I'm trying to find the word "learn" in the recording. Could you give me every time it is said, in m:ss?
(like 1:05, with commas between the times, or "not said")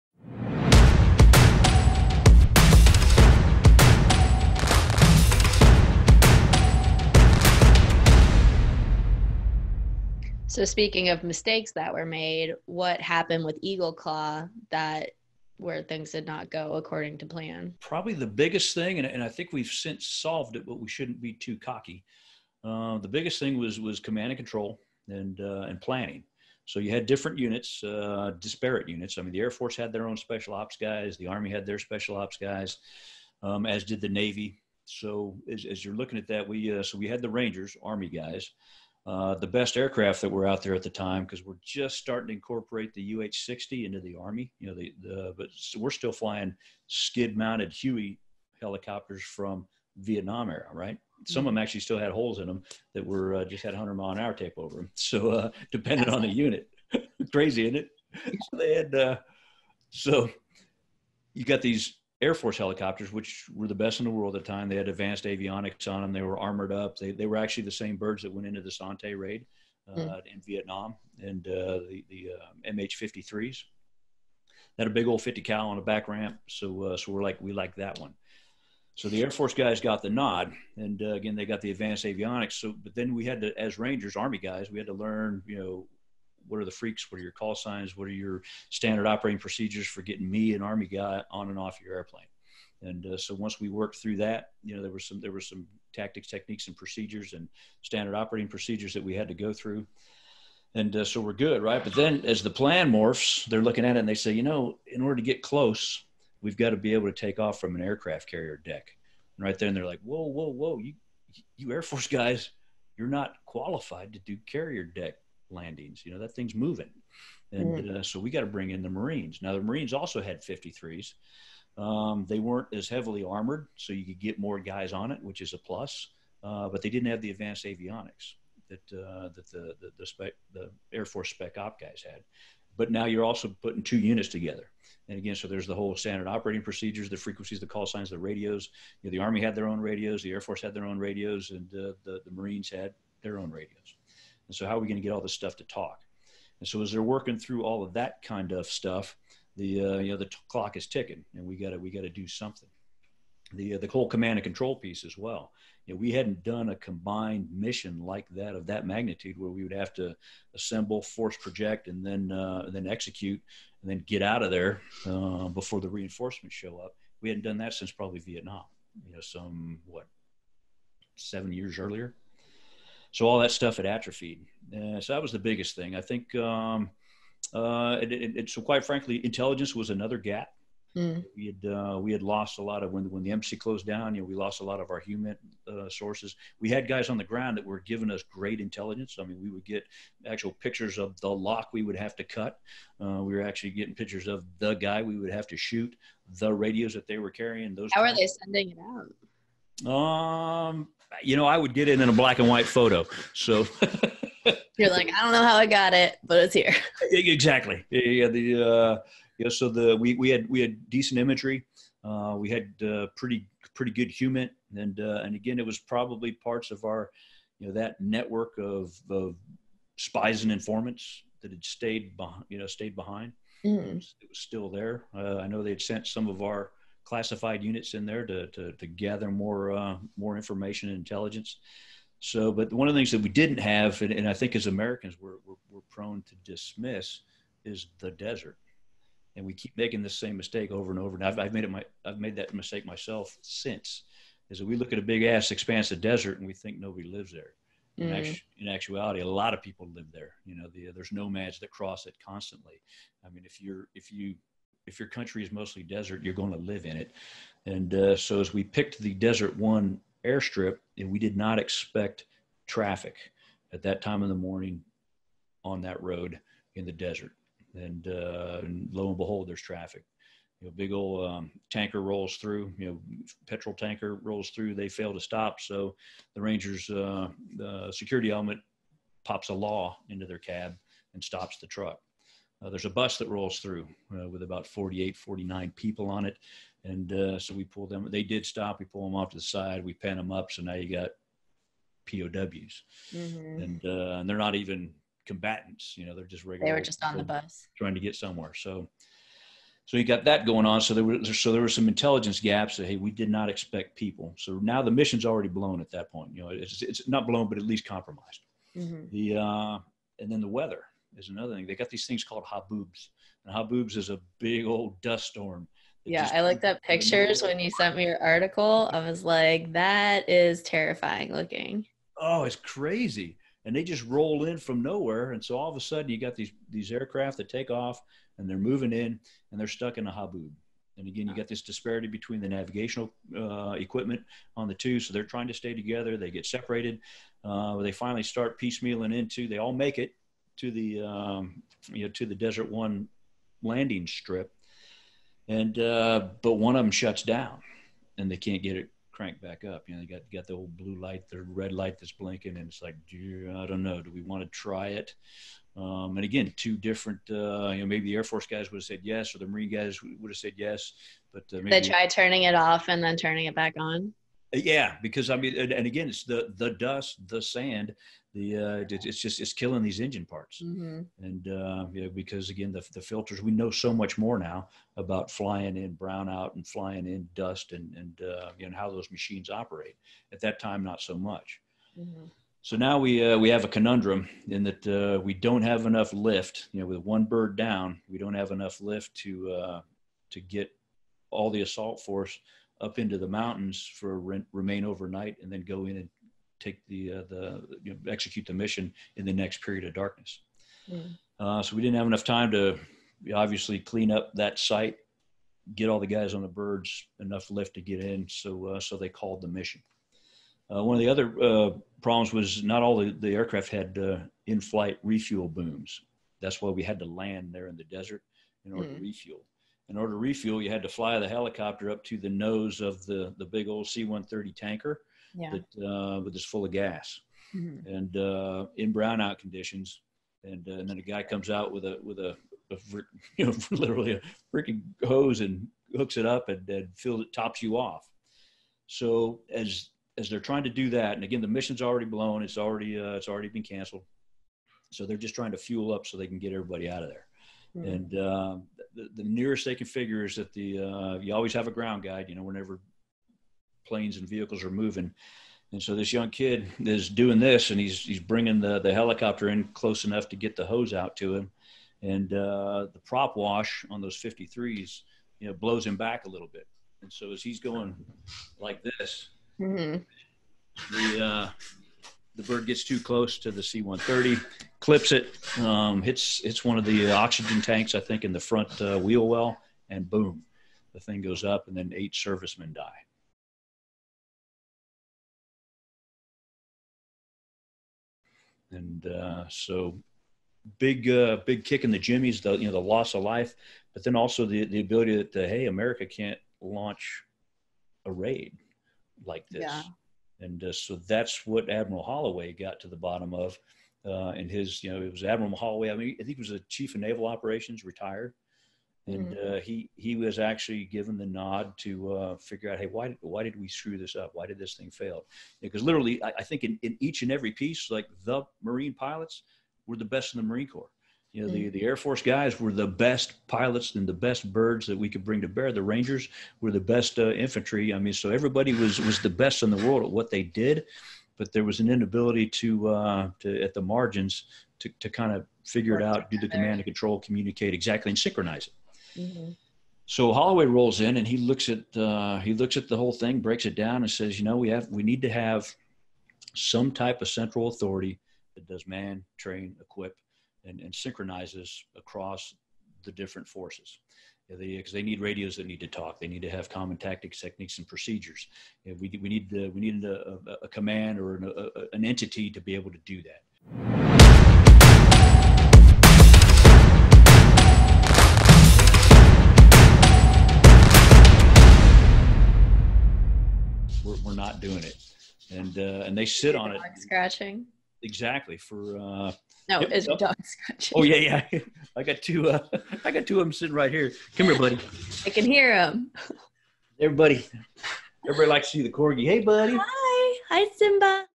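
1:24.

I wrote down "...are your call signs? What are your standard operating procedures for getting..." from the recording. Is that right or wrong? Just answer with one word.
right.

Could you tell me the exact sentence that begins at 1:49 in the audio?
And right then they're like, whoa, whoa, whoa, you, you Air Force guys, you're not qualified to do carrier deck landings.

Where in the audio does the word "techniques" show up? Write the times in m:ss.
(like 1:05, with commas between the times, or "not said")
1:36, 9:17.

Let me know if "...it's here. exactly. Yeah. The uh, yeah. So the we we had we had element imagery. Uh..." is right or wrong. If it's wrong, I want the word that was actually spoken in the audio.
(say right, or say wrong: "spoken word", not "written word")
wrong: "decent", not "element".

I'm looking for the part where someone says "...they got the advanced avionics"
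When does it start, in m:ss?
1:21.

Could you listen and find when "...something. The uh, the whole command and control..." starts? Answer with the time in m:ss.
2:32.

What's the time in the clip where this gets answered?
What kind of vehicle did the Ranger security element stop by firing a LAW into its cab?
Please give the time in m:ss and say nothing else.
4:33.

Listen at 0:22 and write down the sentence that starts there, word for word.
Uh, the biggest thing was was command and control and uh, and planning.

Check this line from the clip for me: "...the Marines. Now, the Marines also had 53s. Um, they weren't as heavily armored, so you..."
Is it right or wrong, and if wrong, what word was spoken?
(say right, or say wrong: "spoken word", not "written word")
right.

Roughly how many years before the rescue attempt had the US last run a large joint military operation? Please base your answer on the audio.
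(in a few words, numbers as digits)
7.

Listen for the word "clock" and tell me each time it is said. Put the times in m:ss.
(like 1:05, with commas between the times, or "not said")
2:30.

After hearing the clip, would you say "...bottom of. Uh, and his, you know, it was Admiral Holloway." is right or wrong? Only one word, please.
right.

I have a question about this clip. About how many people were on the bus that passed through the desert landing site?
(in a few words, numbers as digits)
48 or 49.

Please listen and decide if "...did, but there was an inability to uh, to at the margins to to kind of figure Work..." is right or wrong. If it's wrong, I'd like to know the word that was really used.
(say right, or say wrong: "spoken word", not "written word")
right.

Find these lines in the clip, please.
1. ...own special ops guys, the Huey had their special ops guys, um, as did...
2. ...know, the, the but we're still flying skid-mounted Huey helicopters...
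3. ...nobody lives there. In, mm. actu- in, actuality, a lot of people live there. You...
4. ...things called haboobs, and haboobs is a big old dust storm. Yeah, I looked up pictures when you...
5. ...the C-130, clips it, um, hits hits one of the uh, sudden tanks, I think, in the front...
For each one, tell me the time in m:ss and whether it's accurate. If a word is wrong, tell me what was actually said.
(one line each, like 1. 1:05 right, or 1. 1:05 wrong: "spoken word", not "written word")
1. 0:30 wrong: "Army", not "Huey"
2. 0:44 right
3. 4:06 right
4. 5:12 right
5. 7:53 wrong: "oxygen", not "sudden".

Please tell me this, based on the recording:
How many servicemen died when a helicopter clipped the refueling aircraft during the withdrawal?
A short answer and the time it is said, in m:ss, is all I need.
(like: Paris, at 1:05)
8, at 8:01.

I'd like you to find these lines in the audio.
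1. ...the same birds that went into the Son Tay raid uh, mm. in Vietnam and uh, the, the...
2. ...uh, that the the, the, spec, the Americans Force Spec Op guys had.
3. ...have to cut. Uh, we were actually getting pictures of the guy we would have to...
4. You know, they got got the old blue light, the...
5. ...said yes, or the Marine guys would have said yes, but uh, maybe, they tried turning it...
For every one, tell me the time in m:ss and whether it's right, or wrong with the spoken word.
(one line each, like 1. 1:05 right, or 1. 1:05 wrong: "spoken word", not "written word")
1. 1:07 right
2. 2:08 wrong: "Air", not "Americans"
3. 3:11 right
4. 5:49 right
5. 5:58 right.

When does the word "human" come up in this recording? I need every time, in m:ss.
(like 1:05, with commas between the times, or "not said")
3:04, 3:34.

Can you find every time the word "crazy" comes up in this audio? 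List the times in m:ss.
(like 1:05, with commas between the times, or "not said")
0:57, 5:22.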